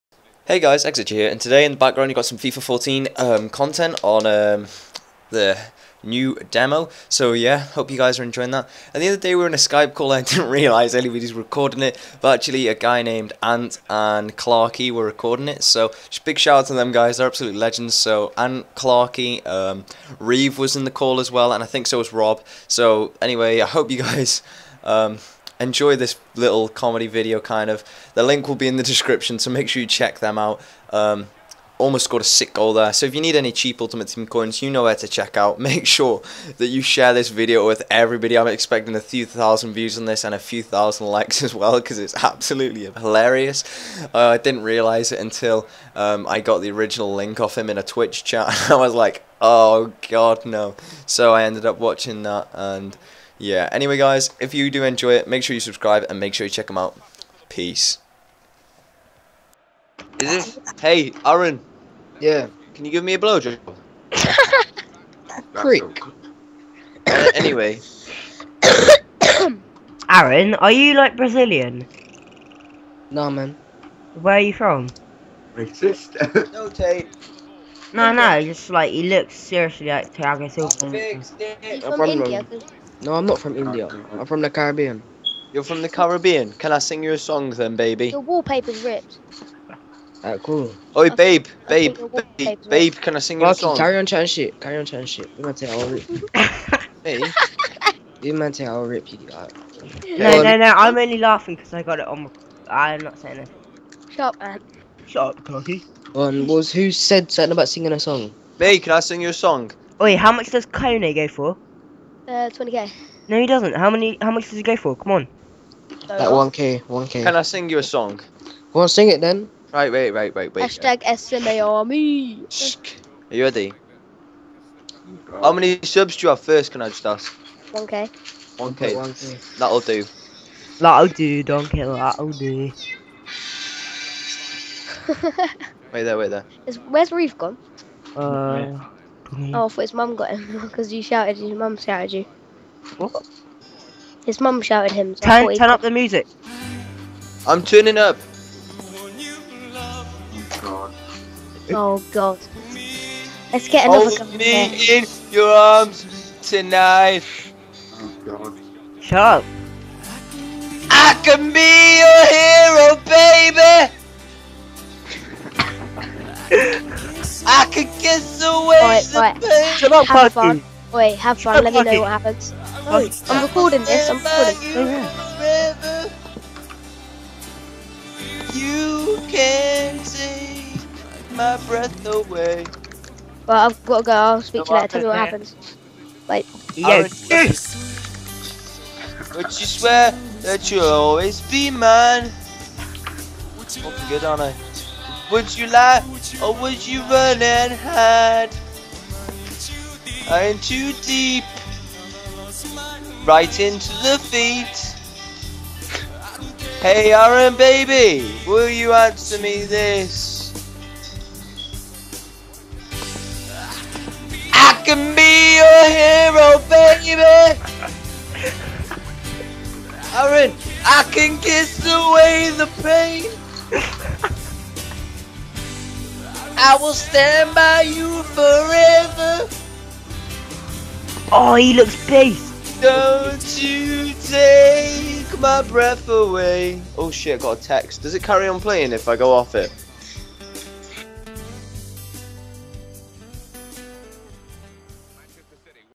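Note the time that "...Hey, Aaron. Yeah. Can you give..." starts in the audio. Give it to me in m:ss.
1:00.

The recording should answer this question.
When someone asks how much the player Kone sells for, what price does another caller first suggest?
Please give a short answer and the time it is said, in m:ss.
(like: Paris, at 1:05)
20k, at 1:52.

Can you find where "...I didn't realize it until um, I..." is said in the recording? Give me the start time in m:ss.
0:44.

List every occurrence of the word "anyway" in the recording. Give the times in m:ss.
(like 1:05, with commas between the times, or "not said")
0:23, 0:53, 1:07.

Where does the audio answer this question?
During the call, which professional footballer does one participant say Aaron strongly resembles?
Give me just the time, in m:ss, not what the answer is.
1:20.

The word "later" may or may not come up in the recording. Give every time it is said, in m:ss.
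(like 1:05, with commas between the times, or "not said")
3:04.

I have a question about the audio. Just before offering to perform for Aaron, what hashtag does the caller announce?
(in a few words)
#SMA Army.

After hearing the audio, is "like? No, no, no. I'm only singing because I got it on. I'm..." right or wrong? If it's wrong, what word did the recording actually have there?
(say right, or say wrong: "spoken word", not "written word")
wrong: "laughing", not "singing".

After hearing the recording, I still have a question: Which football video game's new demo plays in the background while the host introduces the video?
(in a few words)
FIFA 14.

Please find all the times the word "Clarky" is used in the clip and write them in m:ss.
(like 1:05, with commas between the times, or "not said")
0:14, 0:18.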